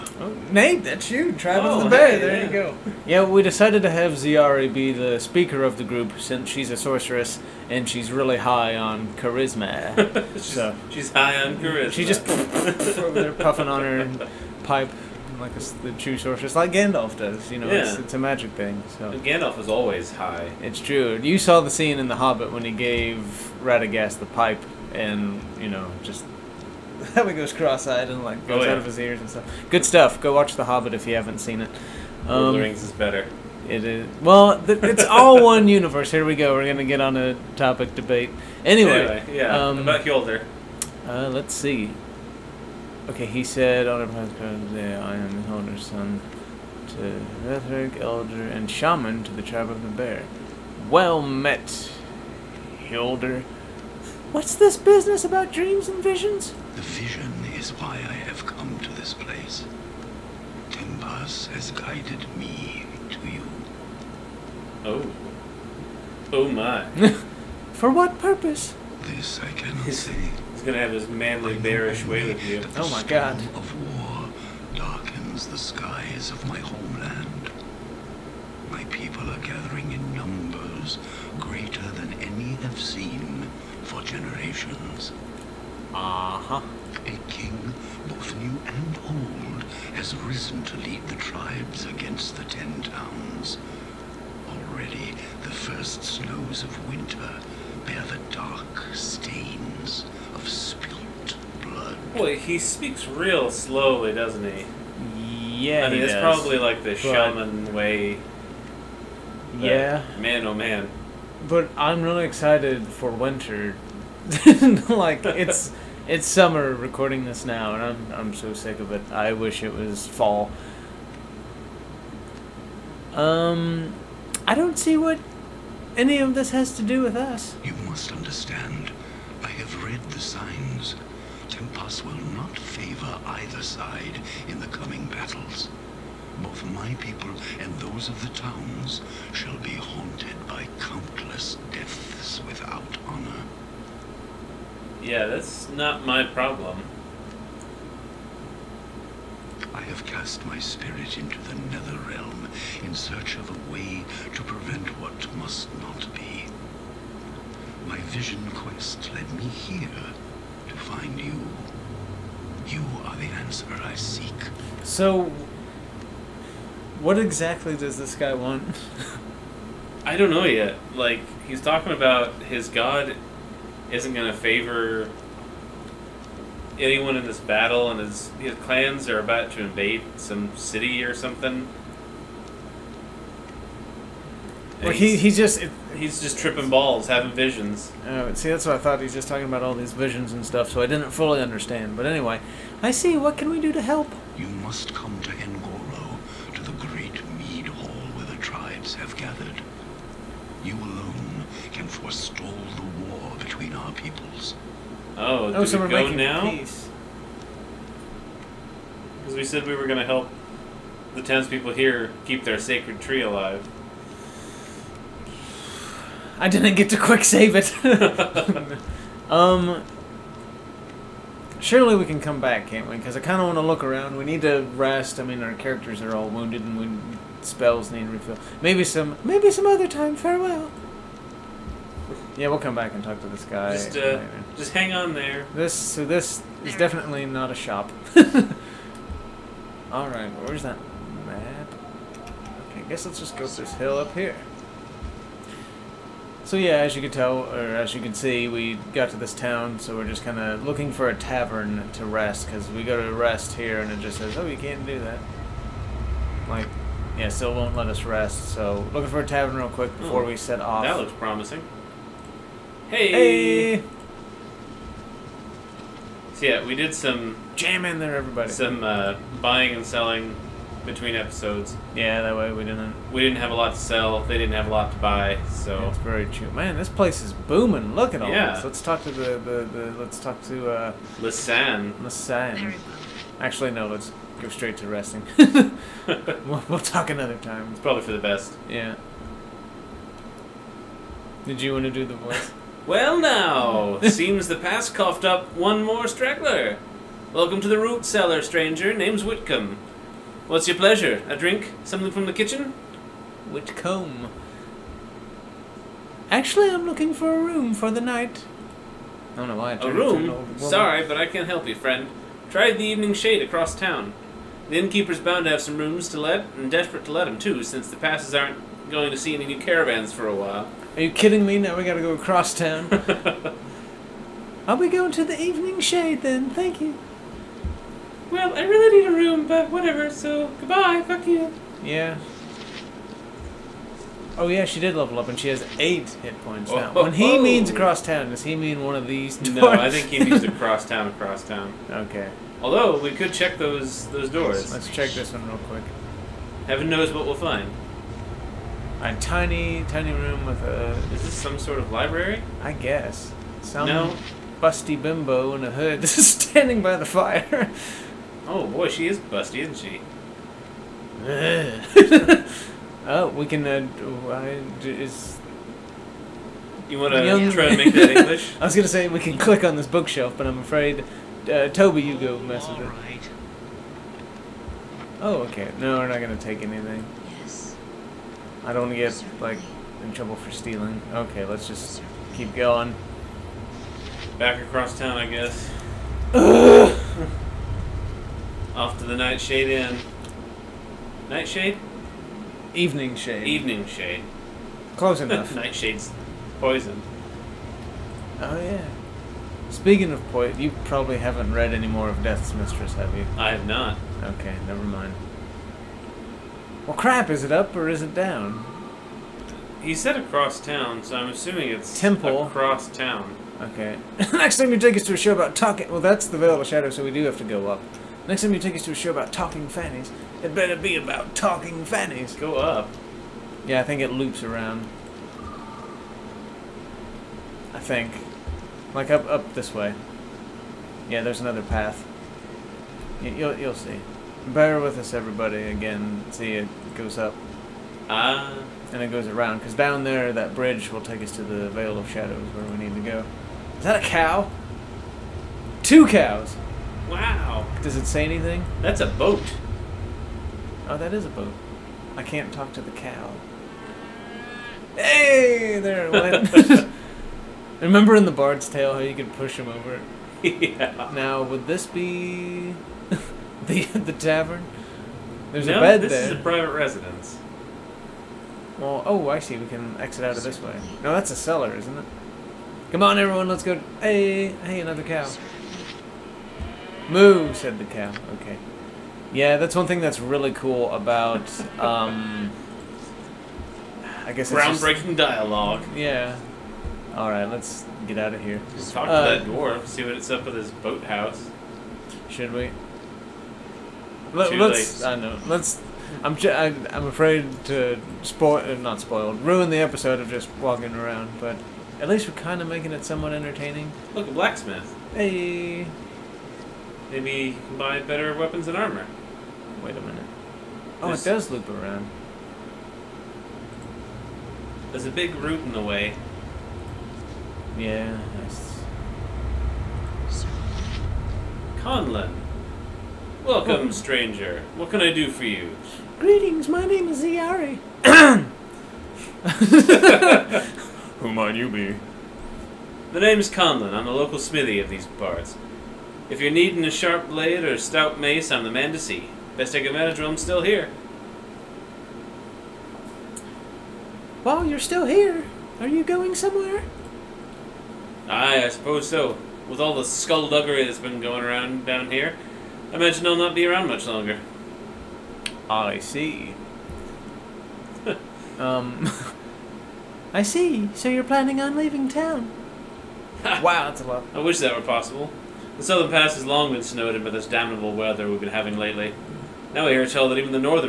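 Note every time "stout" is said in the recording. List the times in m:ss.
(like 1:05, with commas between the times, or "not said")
8:57.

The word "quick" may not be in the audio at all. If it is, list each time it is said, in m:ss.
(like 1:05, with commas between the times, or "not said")
3:36, 4:19, 5:45.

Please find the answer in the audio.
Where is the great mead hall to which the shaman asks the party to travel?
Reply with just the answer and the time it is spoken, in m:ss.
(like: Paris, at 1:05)
Engoro, at 3:15.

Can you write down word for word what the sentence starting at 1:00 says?
Tempus has guided me to you.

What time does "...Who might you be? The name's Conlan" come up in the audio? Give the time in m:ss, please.
8:51.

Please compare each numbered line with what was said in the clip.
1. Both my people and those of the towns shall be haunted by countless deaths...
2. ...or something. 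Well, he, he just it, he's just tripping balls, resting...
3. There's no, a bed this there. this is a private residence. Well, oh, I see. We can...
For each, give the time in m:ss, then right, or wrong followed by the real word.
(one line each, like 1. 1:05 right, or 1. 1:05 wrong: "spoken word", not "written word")
1. 2:16 right
2. 3:01 wrong: "having", not "resting"
3. 7:45 right.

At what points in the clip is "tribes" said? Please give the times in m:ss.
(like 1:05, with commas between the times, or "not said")
0:49, 1:31, 3:18.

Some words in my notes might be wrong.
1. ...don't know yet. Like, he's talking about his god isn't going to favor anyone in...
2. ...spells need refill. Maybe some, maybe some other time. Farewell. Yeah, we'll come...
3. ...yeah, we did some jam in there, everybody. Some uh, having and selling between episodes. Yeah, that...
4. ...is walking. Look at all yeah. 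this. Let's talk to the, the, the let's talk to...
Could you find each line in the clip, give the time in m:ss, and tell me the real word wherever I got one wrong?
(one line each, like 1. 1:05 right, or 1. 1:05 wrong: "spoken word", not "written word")
1. 2:50 right
2. 3:47 right
3. 4:26 wrong: "buying", not "having"
4. 4:37 wrong: "booming", not "walking".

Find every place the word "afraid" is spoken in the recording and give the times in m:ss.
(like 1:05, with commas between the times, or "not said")
6:10, 8:17.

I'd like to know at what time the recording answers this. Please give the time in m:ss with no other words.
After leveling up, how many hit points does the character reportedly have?
5:35.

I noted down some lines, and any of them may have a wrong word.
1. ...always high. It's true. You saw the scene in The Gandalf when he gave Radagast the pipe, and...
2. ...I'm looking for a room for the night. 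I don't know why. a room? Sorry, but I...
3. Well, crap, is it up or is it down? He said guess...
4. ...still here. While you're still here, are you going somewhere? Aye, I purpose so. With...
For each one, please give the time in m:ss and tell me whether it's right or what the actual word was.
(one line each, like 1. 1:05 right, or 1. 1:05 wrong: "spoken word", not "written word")
1. 0:19 wrong: "Hobbit", not "Gandalf"
2. 5:06 right
3. 6:46 wrong: "across", not "guess"
4. 9:00 wrong: "suppose", not "purpose".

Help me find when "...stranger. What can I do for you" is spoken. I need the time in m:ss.
8:43.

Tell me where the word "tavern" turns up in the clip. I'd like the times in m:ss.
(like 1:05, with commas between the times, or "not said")
4:11, 4:19, 7:44.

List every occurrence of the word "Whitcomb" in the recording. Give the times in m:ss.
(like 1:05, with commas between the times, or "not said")
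4:59, 5:03.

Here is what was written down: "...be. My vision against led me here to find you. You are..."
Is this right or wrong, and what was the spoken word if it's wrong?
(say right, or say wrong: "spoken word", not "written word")
wrong: "quest", not "against".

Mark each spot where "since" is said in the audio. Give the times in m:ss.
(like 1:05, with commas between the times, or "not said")
0:06, 5:17.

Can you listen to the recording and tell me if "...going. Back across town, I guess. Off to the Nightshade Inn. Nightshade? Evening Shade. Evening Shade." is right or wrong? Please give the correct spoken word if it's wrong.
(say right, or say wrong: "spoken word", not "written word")
right.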